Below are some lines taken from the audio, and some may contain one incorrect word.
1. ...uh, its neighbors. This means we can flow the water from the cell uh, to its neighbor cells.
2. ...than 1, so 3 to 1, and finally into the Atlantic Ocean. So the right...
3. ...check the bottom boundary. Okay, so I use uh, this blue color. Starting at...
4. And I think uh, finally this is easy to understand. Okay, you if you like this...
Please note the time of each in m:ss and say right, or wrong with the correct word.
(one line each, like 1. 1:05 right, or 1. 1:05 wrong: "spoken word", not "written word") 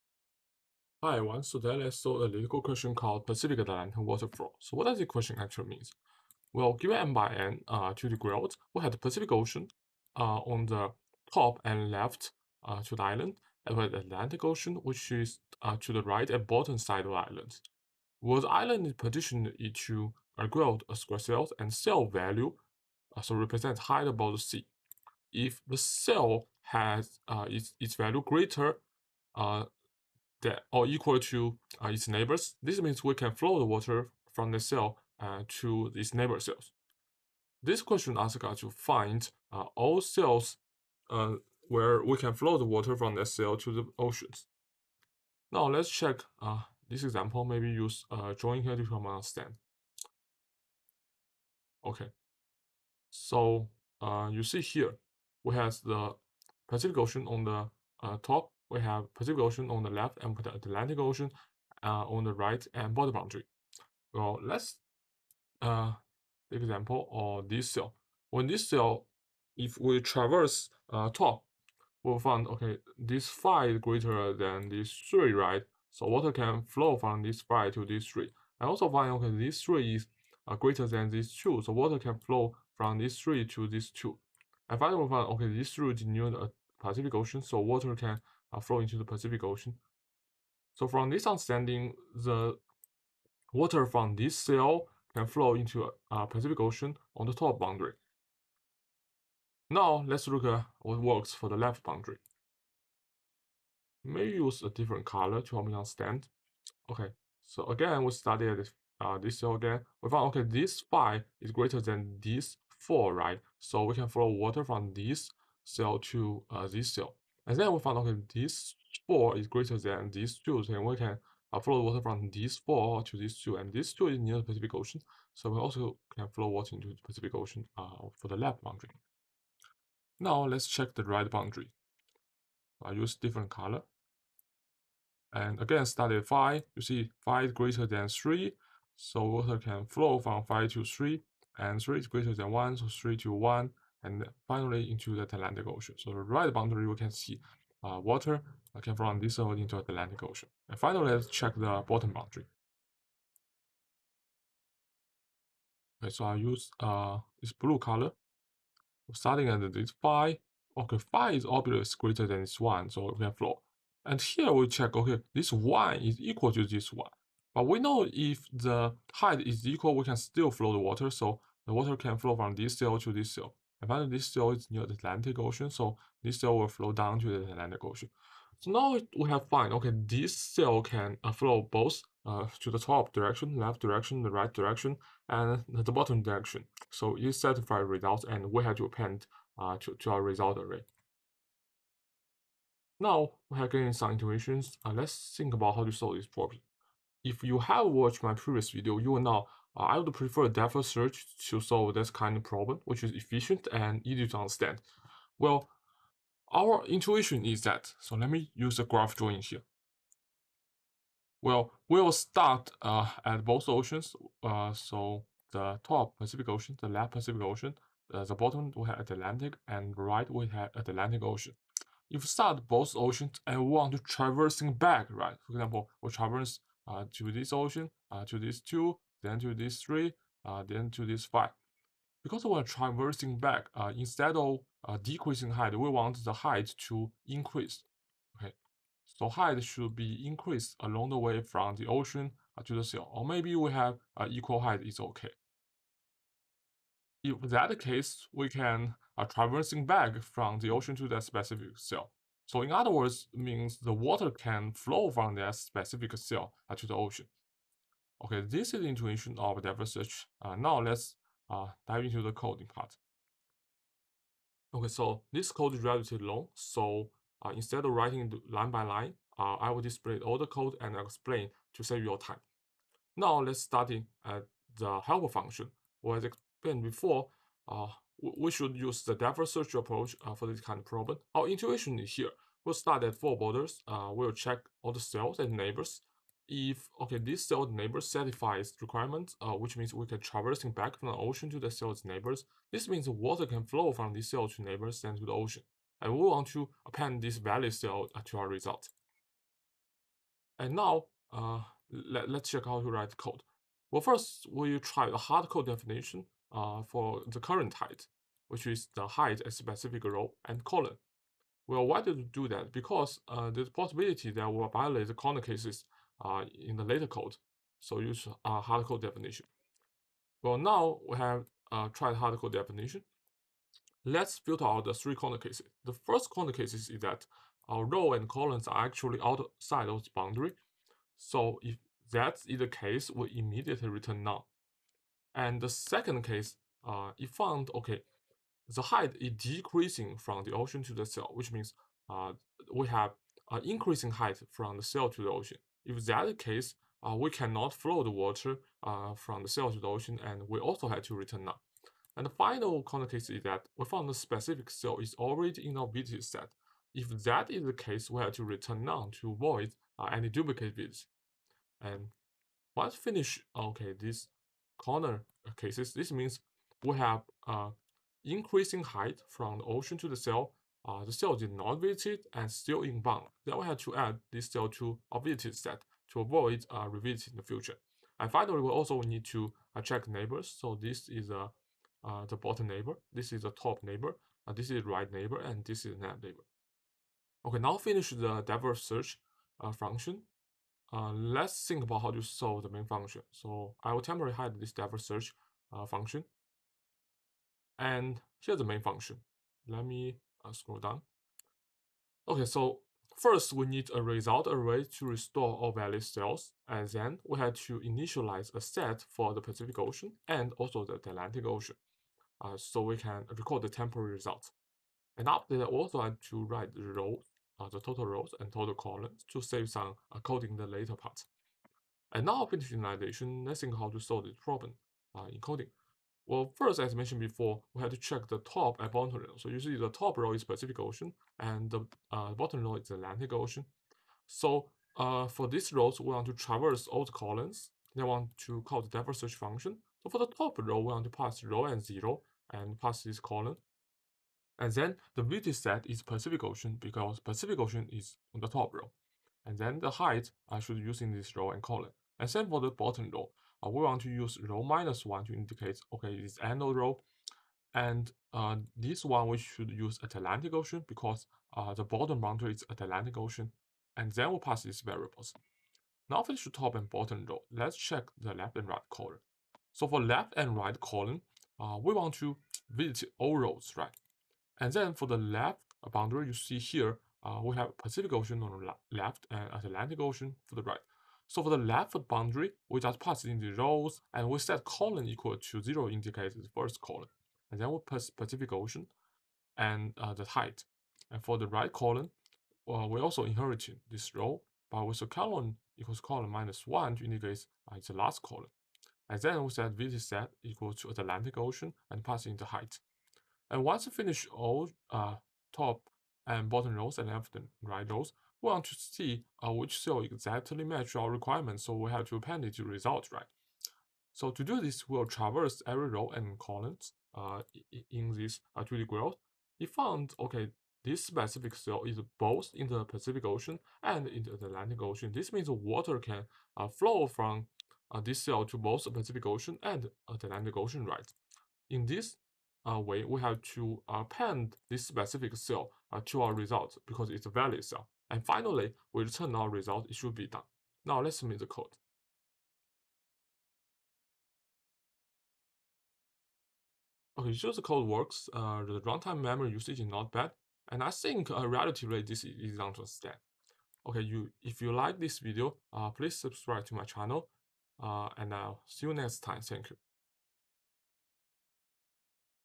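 1. 0:31 right
2. 2:22 right
3. 2:31 right
4. 9:10 wrong: "relatively", not "finally".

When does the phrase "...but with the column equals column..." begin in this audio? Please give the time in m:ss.
8:14.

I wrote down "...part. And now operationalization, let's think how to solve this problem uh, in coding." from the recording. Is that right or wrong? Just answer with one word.
right.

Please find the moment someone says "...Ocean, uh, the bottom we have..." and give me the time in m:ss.
3:37.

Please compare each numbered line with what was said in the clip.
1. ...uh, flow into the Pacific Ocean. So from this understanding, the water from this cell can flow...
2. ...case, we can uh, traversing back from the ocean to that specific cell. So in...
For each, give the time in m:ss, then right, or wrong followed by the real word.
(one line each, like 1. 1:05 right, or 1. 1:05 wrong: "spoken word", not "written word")
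1. 1:28 right
2. 4:07 right.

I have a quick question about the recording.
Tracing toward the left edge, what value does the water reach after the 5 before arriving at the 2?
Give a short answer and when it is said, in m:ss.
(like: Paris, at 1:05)
4, at 1:50.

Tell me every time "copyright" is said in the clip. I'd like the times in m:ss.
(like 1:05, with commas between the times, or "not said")
not said.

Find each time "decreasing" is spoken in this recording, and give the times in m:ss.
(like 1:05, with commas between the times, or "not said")
3:55, 5:39.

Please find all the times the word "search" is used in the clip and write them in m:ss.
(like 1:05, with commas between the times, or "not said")
3:20, 4:19, 4:39, 6:28, 6:35, 7:19.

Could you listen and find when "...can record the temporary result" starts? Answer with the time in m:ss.
6:52.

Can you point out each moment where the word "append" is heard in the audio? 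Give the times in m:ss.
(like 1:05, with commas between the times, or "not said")
3:08, 4:56, 8:32, 8:53.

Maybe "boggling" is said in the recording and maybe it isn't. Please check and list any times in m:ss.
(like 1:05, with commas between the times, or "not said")
not said.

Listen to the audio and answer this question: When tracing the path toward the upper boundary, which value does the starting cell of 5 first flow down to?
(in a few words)
3.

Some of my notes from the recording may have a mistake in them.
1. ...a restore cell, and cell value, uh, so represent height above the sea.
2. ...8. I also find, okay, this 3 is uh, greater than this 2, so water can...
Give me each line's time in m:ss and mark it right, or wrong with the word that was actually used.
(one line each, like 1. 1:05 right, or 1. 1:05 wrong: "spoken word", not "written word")
1. 0:20 wrong: "square", not "restore"
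2. 1:18 wrong: "3", not "8".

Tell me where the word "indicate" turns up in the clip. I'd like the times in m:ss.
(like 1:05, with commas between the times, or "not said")
7:35, 8:05, 8:17.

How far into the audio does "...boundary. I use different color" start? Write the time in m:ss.
2:11.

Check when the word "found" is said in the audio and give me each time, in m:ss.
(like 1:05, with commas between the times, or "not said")
1:50, 2:59, 5:37, 5:53, 8:39.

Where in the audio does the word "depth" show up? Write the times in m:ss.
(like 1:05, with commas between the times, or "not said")
3:20, 4:19, 4:39, 7:18.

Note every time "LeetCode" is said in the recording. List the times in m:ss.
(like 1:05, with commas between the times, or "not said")
0:02.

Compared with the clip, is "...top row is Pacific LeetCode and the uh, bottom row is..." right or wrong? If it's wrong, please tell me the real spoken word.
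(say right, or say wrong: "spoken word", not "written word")
wrong: "Ocean", not "LeetCode".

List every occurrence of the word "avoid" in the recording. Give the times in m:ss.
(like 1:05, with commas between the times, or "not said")
5:59, 6:16.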